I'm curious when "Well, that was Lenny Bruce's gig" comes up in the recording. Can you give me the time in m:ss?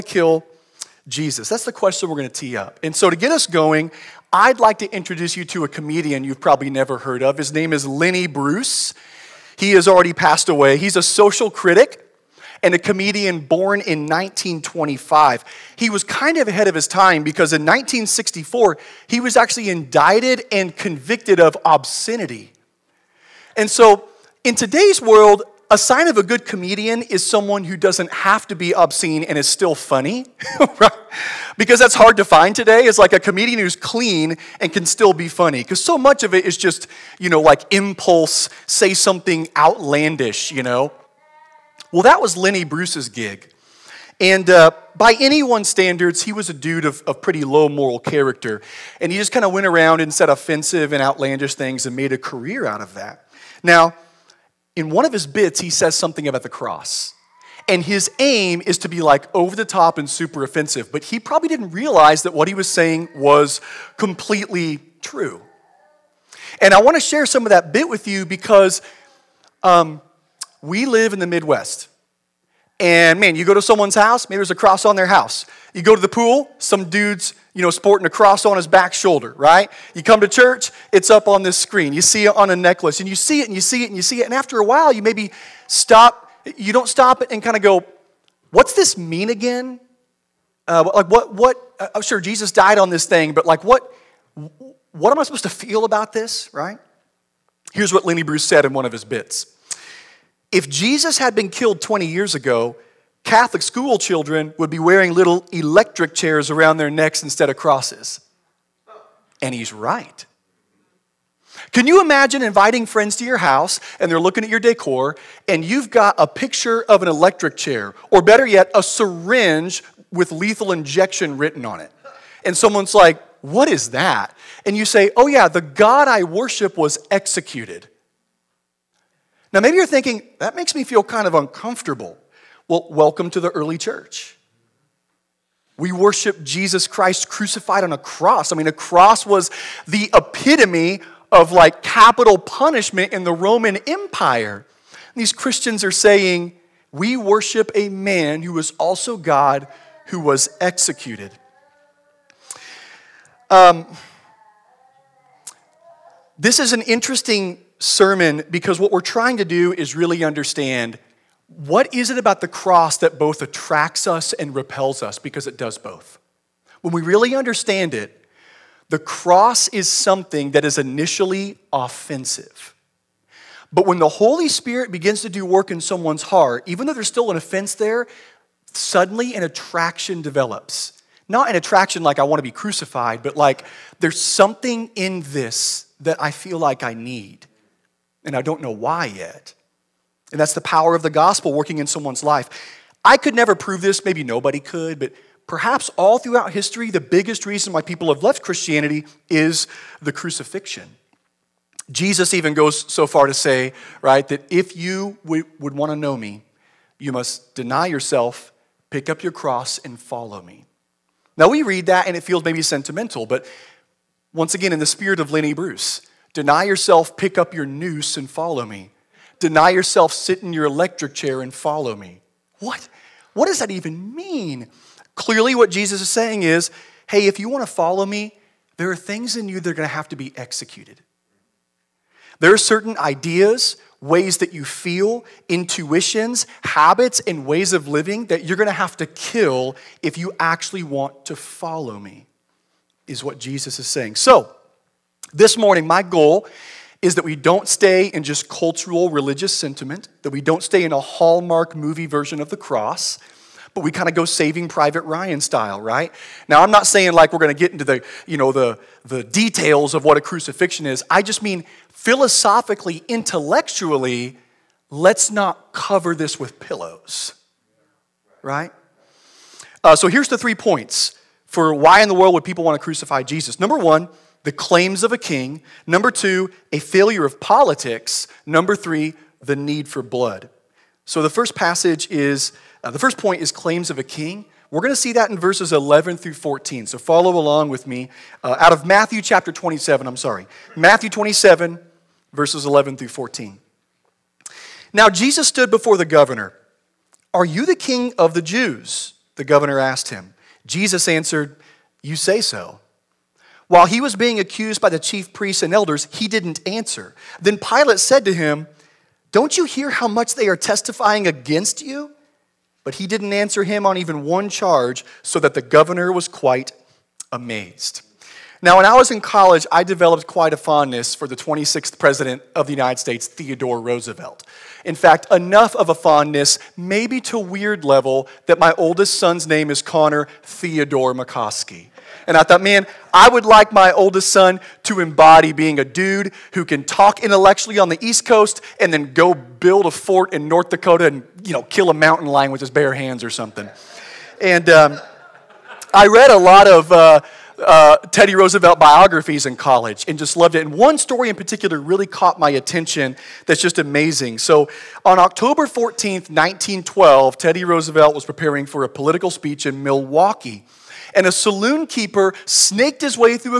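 0:41.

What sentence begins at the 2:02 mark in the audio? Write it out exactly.
And someone's like, What is that?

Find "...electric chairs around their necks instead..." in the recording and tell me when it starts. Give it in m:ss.
1:45.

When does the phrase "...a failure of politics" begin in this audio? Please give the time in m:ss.
4:36.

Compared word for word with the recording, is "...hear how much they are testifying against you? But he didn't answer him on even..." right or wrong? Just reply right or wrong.
right.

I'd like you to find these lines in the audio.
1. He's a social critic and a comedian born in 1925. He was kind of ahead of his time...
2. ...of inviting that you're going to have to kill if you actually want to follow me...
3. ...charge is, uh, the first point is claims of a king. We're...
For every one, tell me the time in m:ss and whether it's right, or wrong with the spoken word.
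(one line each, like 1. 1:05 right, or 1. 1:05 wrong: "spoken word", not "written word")
1. 0:10 right
2. 3:57 wrong: "living", not "inviting"
3. 4:41 wrong: "passage", not "charge".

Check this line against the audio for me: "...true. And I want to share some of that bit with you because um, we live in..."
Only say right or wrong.
right.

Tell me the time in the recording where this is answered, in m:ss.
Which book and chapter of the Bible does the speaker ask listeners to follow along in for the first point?
4:48.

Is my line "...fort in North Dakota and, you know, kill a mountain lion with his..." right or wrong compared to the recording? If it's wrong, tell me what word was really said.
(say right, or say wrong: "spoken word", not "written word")
right.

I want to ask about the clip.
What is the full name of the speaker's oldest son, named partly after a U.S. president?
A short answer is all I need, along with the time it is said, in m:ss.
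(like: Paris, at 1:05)
Connor Theodore McCoskey, at 5:29.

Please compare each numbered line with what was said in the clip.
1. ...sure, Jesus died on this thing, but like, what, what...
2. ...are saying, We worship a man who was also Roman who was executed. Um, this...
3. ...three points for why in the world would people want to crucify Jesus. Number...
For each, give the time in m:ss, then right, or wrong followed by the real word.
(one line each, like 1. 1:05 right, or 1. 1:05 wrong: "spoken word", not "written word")
1. 1:31 right
2. 2:25 wrong: "God", not "Roman"
3. 4:30 right.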